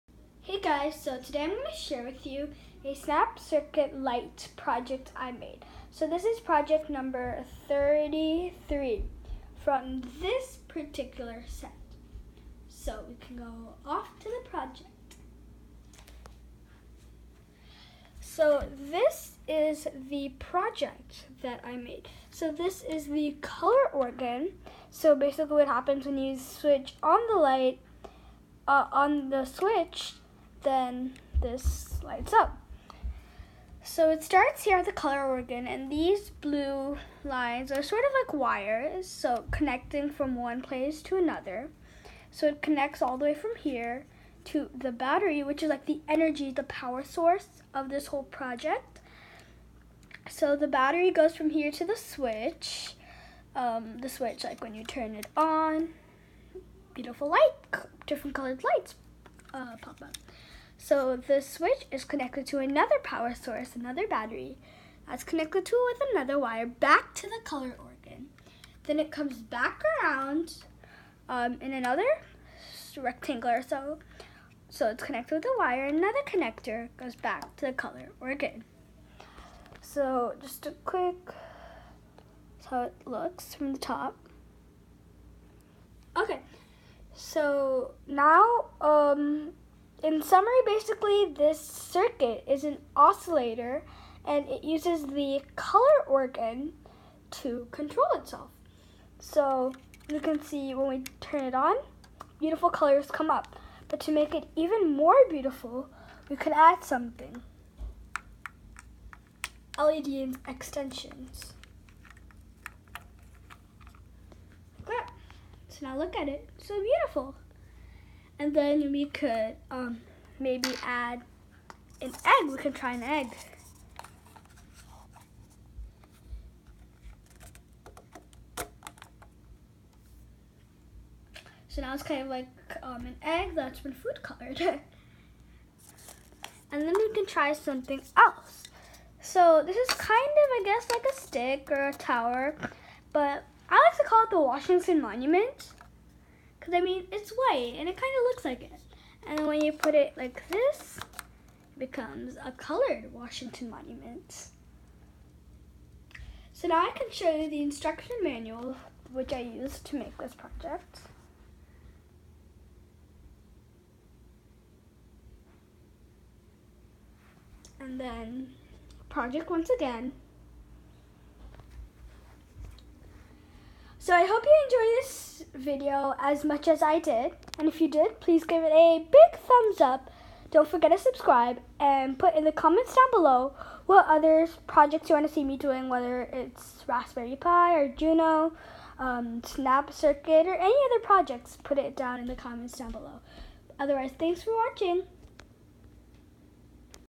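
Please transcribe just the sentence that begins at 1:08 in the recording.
Then it comes back around um, in another rectangle or so.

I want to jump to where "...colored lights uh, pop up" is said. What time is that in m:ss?
0:58.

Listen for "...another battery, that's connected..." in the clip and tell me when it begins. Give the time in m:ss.
1:03.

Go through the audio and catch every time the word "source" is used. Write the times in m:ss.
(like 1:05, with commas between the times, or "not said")
0:47, 1:03.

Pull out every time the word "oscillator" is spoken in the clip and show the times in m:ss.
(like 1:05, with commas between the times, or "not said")
1:32.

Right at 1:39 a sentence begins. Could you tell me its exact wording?
So you can see when we turn it on, beautiful colors come up.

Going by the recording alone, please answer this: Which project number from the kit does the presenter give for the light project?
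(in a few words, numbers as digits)
33.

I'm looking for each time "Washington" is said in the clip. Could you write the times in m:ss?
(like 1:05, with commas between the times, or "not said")
2:24, 2:33.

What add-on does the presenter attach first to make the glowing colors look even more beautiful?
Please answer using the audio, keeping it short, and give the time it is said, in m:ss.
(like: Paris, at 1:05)
LED extensions, at 1:49.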